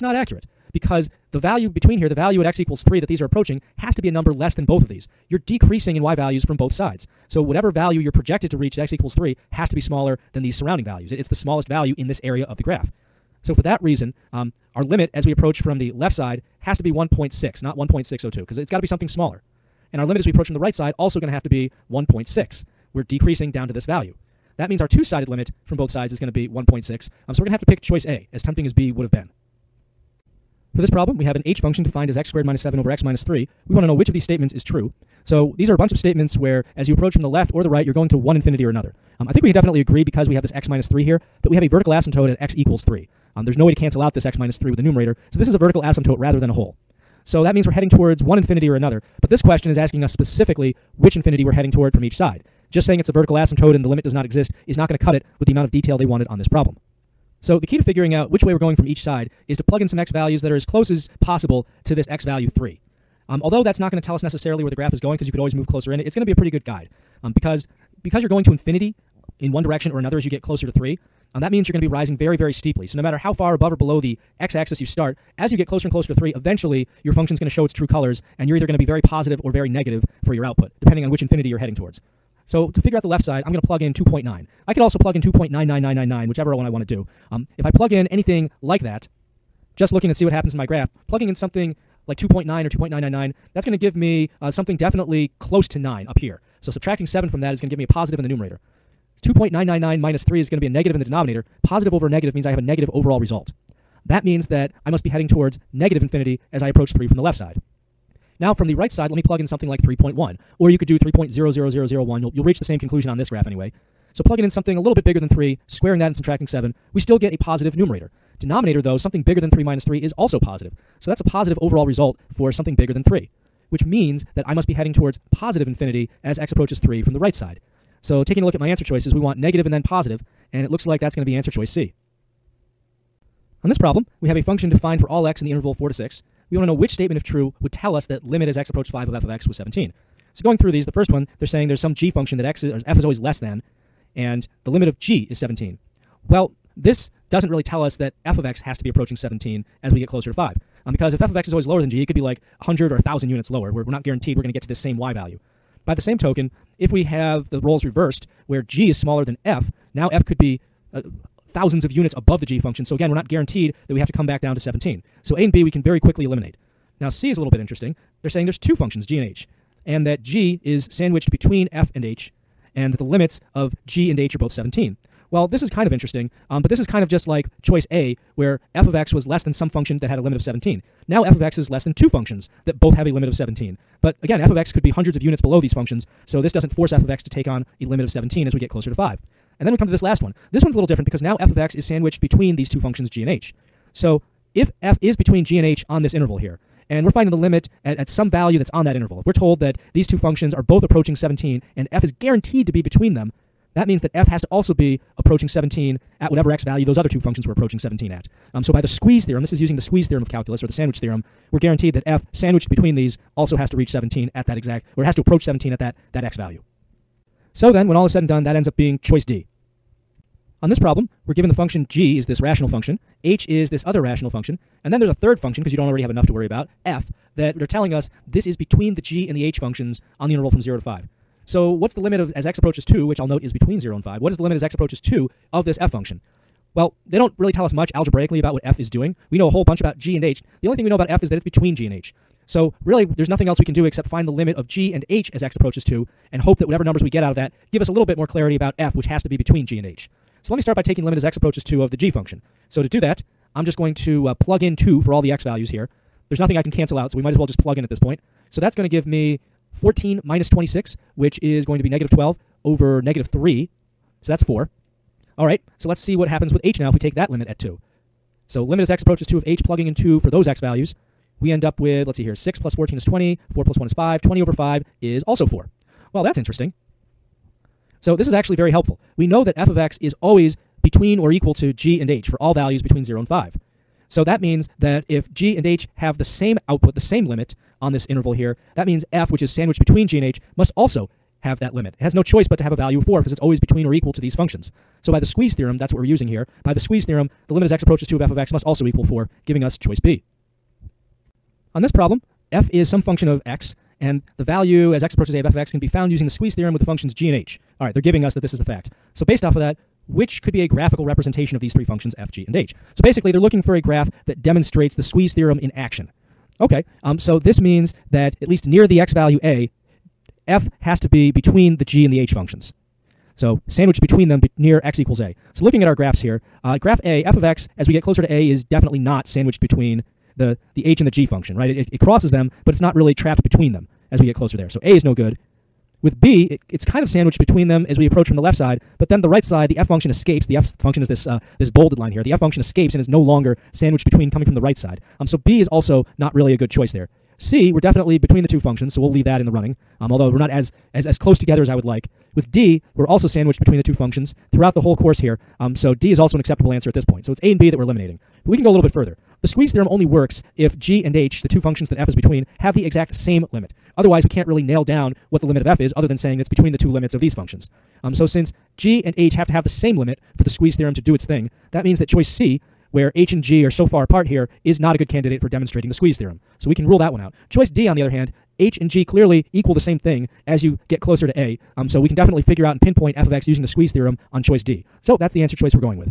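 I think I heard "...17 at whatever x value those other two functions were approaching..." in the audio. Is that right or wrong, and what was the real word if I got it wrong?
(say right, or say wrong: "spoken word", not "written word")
right.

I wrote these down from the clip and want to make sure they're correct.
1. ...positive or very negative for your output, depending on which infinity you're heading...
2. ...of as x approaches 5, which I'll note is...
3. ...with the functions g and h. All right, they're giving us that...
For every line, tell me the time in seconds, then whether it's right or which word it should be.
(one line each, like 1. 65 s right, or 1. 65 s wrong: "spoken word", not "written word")
1. 79 s right
2. 232 s wrong: "2", not "5"
3. 306 s right.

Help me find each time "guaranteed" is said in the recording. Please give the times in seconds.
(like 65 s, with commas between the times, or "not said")
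154 s, 163 s, 202 s, 211 s.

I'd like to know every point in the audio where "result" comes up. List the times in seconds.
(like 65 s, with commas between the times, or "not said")
103 s, 121 s.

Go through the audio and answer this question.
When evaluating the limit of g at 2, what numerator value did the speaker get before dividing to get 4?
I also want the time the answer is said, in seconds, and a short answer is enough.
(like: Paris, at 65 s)
-12, at 261 s.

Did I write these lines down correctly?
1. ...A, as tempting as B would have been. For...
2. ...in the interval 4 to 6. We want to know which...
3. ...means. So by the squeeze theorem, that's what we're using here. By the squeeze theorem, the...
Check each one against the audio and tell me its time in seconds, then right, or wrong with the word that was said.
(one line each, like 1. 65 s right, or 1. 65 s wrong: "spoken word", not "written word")
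1. 28 s right
2. 135 s right
3. 294 s wrong: "functions", not "means".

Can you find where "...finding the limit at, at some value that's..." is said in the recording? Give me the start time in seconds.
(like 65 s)
197 s.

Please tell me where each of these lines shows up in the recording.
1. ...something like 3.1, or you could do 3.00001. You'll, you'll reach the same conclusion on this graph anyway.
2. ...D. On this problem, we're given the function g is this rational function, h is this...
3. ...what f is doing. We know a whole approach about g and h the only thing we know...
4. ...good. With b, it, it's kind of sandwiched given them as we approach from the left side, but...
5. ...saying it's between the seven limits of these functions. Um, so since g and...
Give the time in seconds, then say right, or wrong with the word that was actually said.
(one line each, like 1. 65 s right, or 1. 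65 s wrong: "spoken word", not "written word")
1. 109 s right
2. 219 s right
3. 238 s wrong: "bunch", not "approach"
4. 335 s wrong: "between", not "given"
5. 366 s wrong: "two", not "seven".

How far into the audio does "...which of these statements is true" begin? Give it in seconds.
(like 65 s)
33 s.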